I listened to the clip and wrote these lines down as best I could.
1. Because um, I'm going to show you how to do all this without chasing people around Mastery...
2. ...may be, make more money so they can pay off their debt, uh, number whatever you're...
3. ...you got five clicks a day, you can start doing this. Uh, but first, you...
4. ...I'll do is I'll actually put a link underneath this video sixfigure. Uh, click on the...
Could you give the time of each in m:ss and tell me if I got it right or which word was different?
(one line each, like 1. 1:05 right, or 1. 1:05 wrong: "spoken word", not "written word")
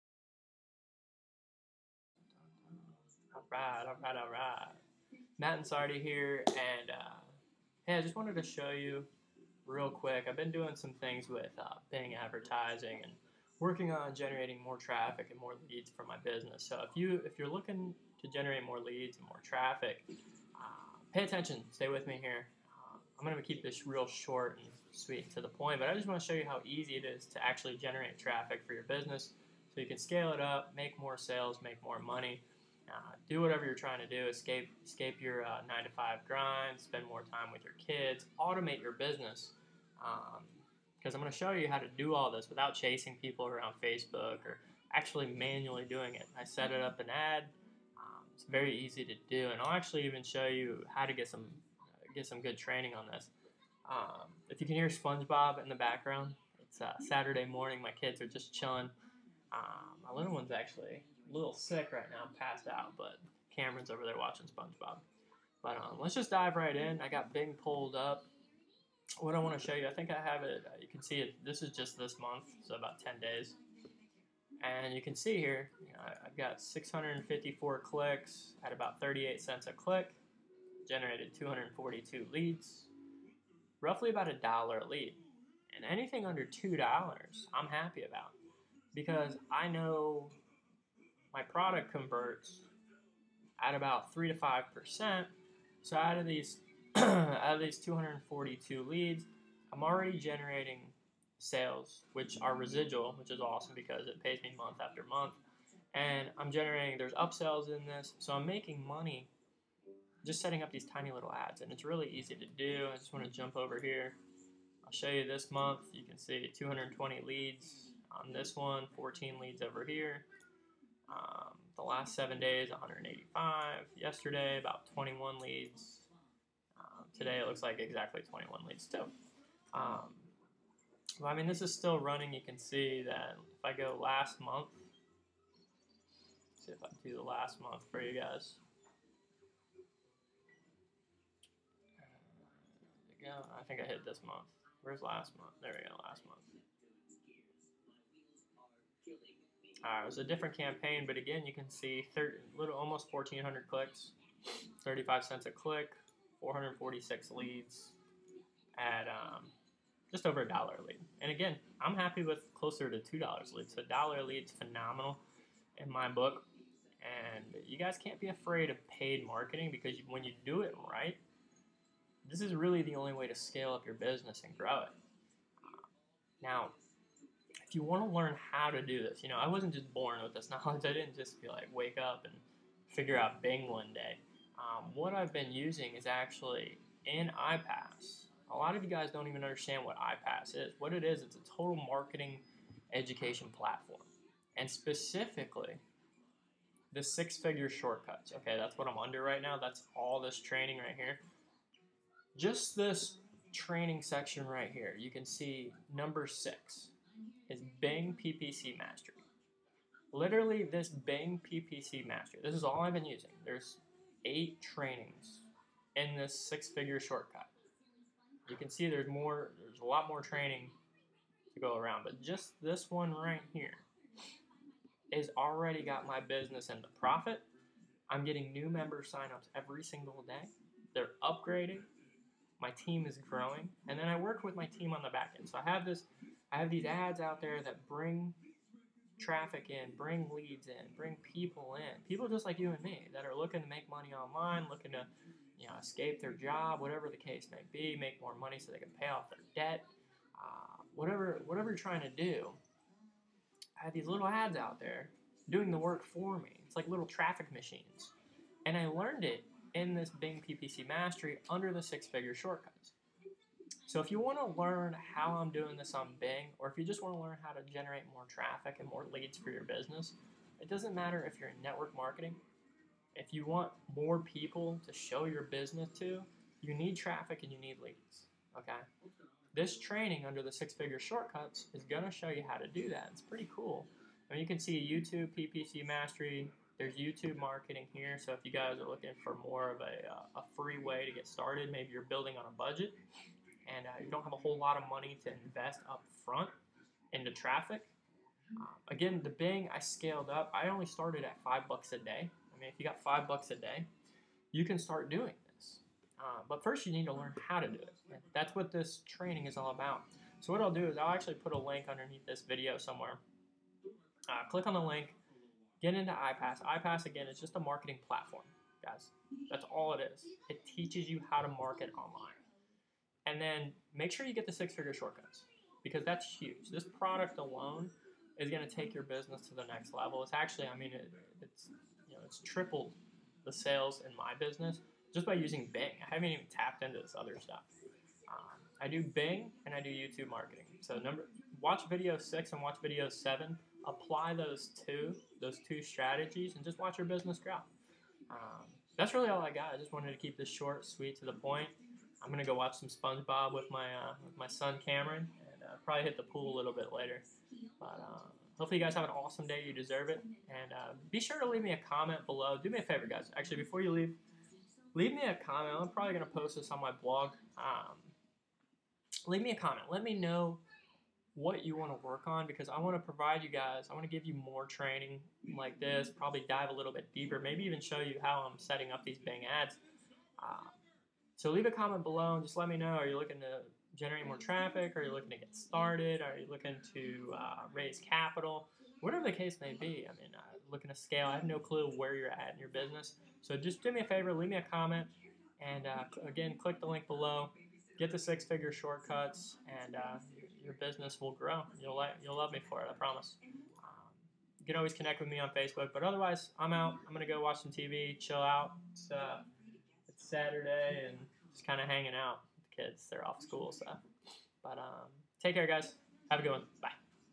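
1. 0:39 wrong: "Facebook", not "Mastery"
2. 4:07 wrong: "whatever", not "number"
3. 5:02 wrong: "bucks", not "clicks"
4. 5:10 wrong: "somewhere", not "sixfigure".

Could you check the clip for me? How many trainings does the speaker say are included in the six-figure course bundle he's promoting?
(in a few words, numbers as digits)
8.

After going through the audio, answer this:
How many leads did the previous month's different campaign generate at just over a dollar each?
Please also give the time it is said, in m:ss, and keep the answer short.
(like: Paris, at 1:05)
446, at 2:36.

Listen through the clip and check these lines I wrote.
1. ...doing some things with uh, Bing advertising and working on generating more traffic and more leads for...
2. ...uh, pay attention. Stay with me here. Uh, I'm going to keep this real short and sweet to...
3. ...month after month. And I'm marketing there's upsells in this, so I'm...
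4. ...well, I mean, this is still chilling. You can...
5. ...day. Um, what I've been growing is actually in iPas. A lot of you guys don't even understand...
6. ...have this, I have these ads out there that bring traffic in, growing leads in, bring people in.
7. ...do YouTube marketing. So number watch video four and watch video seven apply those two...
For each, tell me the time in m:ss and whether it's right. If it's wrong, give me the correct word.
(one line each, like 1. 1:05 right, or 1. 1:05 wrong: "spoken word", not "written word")
1. 0:10 right
2. 0:20 right
3. 1:44 wrong: "generating", not "marketing"
4. 2:11 wrong: "running", not "chilling"
5. 3:03 wrong: "using", not "growing"
6. 3:55 wrong: "bring", not "growing"
7. 5:39 wrong: "six", not "four".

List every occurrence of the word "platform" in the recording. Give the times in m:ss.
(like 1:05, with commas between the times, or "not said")
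3:13, 5:18.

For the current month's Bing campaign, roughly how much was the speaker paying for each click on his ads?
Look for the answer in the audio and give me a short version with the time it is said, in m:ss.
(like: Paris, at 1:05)
38 cents, at 1:19.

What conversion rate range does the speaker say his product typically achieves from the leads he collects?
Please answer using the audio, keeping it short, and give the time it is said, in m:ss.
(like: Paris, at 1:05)
3 to 5%, at 1:34.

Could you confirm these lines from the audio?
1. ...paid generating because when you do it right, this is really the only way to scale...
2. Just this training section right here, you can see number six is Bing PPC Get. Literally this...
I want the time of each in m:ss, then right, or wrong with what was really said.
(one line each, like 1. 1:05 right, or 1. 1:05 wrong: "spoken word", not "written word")
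1. 2:48 wrong: "marketing", not "generating"
2. 3:22 wrong: "Master", not "Get".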